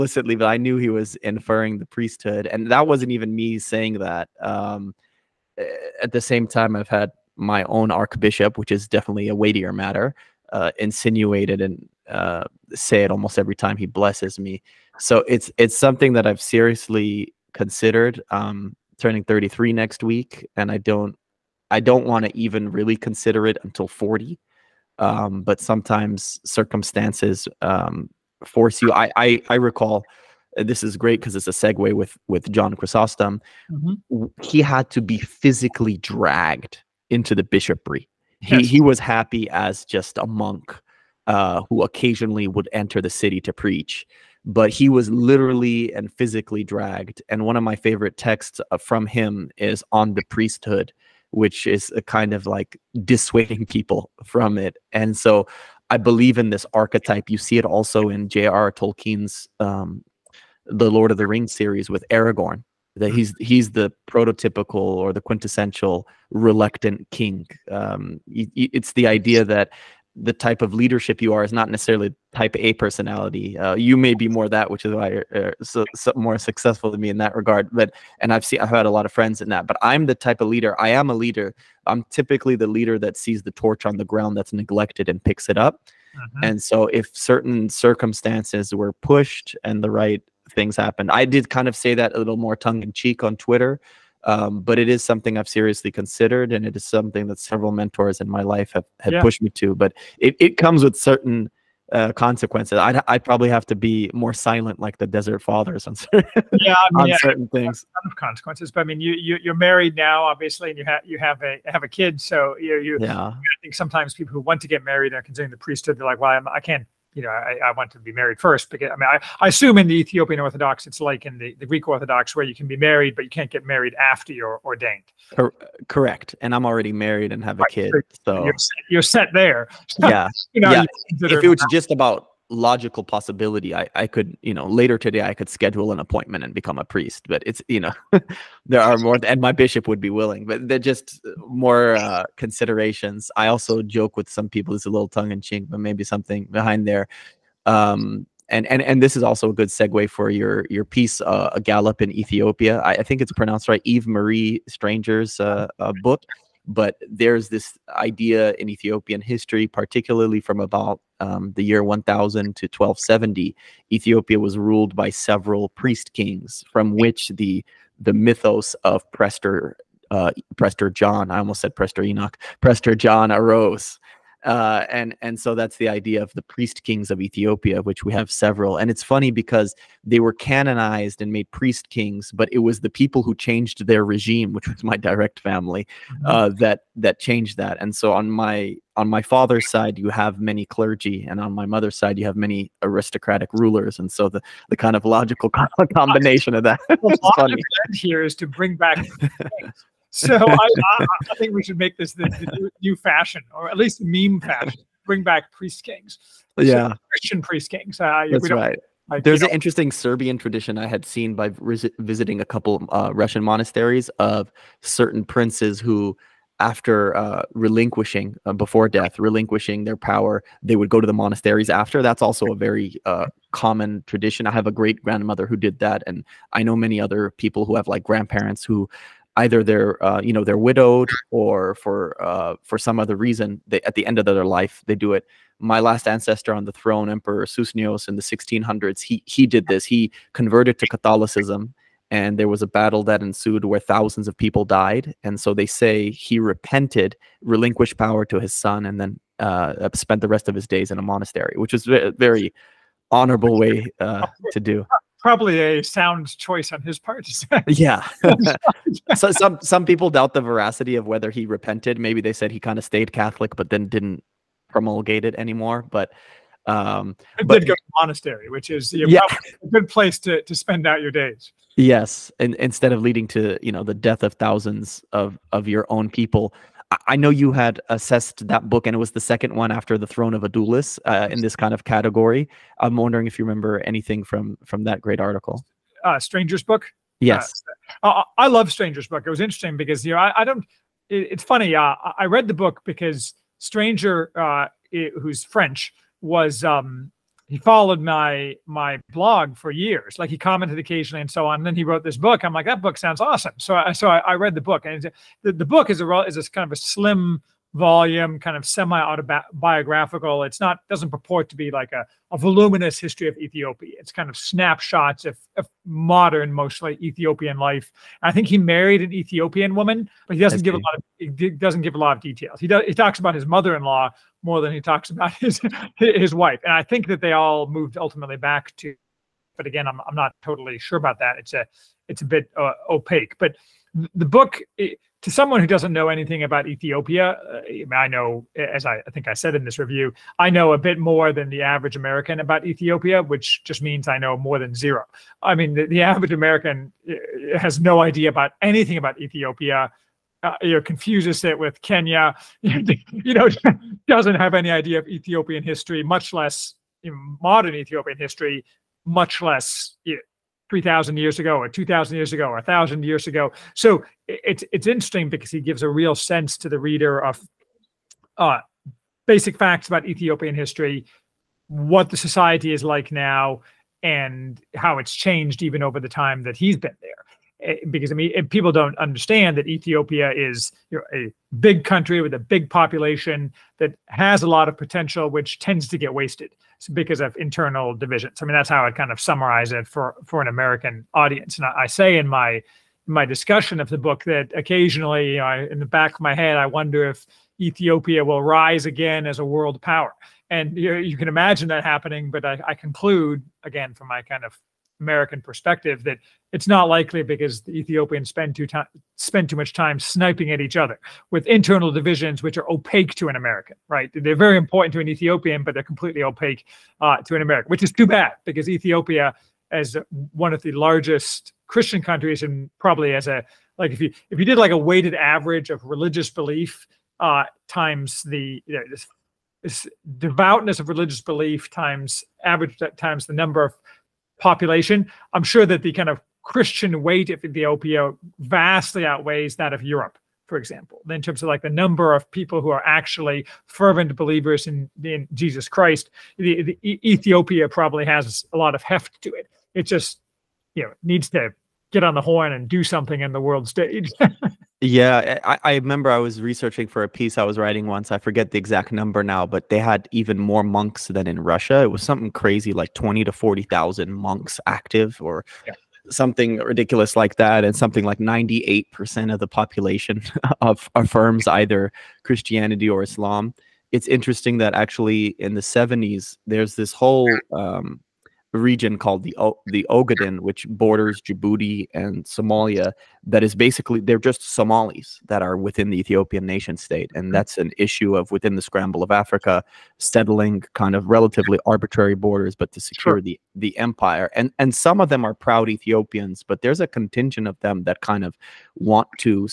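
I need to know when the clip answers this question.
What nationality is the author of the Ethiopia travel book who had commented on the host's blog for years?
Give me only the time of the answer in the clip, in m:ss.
4:55.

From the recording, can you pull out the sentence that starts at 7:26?
The, the Ethiopia probably has a lot of heft to it.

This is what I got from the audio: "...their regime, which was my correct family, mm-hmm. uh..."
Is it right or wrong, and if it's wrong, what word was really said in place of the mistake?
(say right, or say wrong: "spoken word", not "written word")
wrong: "direct", not "correct".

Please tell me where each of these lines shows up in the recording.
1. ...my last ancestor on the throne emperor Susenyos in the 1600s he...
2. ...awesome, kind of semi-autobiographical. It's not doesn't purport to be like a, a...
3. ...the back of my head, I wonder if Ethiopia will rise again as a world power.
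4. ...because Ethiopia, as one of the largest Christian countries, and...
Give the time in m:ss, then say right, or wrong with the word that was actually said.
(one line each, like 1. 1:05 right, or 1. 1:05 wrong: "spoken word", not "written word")
1. 3:55 right
2. 5:07 wrong: "volume", not "awesome"
3. 6:35 right
4. 6:58 right.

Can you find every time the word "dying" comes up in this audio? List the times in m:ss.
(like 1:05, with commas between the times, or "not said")
not said.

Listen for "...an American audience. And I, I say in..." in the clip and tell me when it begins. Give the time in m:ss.
6:30.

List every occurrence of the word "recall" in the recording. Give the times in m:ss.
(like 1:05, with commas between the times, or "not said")
0:29.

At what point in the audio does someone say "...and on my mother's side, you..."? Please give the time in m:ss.
3:11.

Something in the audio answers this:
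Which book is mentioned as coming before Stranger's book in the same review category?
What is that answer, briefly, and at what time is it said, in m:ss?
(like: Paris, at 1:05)
The Throne of Adulis, at 4:40.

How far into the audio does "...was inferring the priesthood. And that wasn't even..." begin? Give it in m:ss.
0:00.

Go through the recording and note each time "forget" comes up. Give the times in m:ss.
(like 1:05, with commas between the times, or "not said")
7:38.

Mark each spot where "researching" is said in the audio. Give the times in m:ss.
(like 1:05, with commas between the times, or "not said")
7:36.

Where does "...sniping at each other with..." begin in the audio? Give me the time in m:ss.
6:49.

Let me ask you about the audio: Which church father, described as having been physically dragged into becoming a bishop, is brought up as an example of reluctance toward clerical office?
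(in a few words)
John Chrysostom.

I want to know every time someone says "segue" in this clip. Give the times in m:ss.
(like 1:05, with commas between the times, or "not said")
0:31, 2:29.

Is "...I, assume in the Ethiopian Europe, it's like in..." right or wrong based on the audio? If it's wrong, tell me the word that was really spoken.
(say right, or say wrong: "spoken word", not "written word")
wrong: "Orthodox", not "Europe".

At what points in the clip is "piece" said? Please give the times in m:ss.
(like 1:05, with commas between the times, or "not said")
2:30, 7:37.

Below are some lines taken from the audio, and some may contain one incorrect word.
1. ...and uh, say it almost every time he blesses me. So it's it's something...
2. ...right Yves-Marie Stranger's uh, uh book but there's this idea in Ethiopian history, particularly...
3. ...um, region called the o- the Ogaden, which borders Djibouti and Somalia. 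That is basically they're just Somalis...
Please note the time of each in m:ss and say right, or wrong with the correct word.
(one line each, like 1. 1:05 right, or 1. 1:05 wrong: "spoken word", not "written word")
1. 0:11 right
2. 2:33 right
3. 7:57 right.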